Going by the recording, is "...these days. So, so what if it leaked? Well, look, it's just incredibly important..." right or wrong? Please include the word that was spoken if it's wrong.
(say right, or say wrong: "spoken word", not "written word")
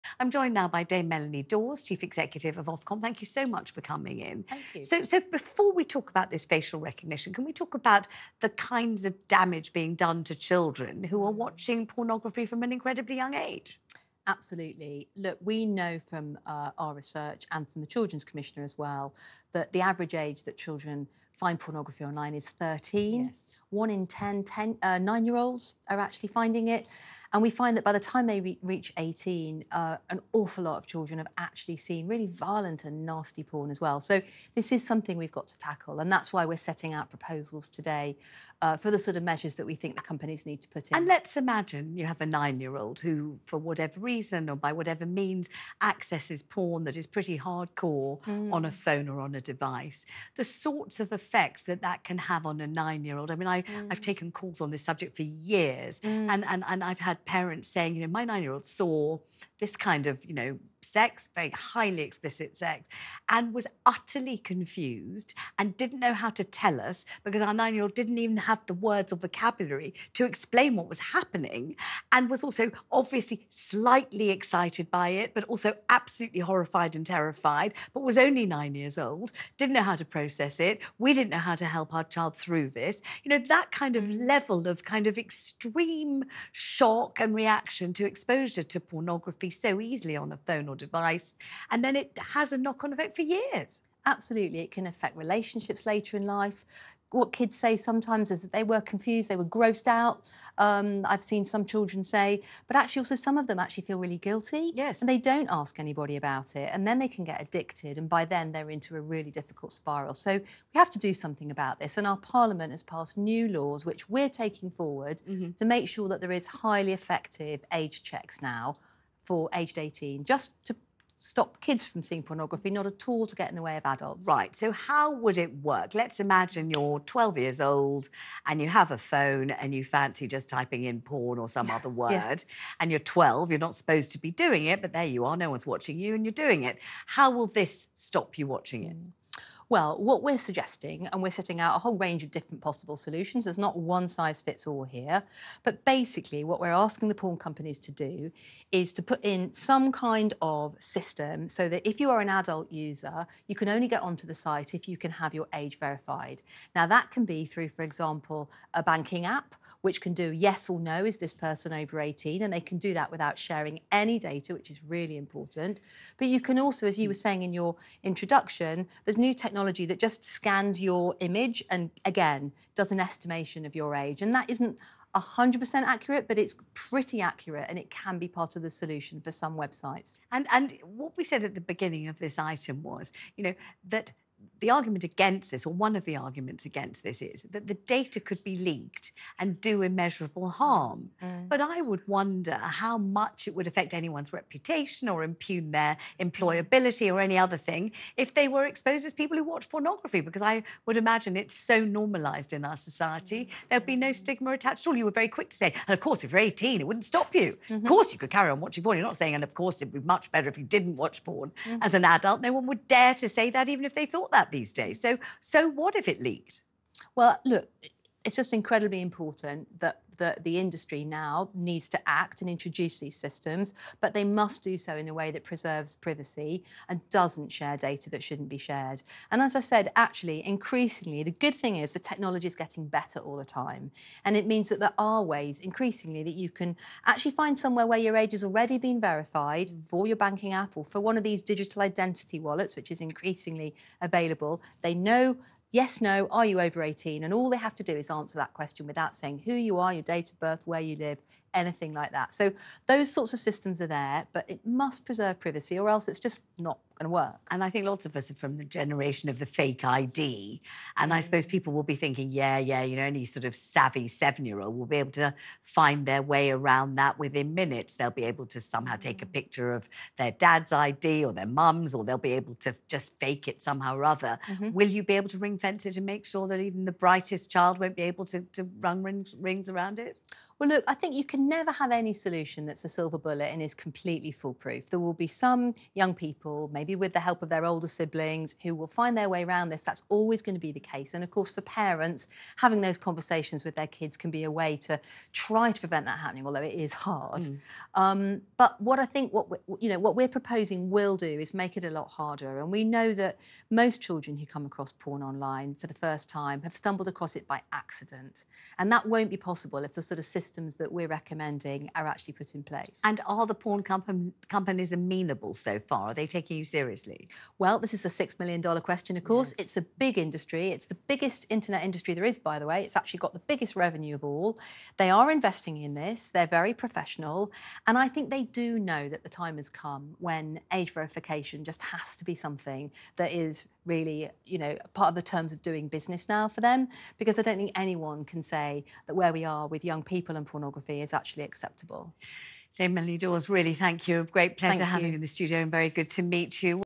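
right.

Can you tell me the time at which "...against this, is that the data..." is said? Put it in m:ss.
3:06.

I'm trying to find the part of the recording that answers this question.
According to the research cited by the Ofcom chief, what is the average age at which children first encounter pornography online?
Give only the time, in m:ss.
0:22.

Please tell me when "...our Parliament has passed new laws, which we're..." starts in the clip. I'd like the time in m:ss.
1:52.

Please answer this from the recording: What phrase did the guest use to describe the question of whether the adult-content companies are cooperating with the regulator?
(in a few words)
the $6 million question.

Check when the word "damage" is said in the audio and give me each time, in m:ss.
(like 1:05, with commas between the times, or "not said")
0:09.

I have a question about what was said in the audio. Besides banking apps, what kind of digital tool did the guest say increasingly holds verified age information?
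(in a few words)
digital identity wallets.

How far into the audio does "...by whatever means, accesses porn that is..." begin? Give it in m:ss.
0:44.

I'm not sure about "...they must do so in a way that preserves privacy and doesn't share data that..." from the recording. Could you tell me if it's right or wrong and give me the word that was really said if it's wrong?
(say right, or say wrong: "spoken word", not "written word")
right.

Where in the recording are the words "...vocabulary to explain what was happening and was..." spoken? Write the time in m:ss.
1:09.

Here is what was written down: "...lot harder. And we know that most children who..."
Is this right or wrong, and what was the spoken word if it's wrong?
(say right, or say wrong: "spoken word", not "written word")
right.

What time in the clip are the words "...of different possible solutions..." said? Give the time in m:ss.
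2:22.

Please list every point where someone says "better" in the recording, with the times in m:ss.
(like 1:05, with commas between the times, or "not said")
3:30, 3:52.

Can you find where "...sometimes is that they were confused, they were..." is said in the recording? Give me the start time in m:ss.
1:37.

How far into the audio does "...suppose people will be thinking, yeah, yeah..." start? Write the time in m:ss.
4:21.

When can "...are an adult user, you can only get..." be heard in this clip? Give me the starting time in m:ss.
2:32.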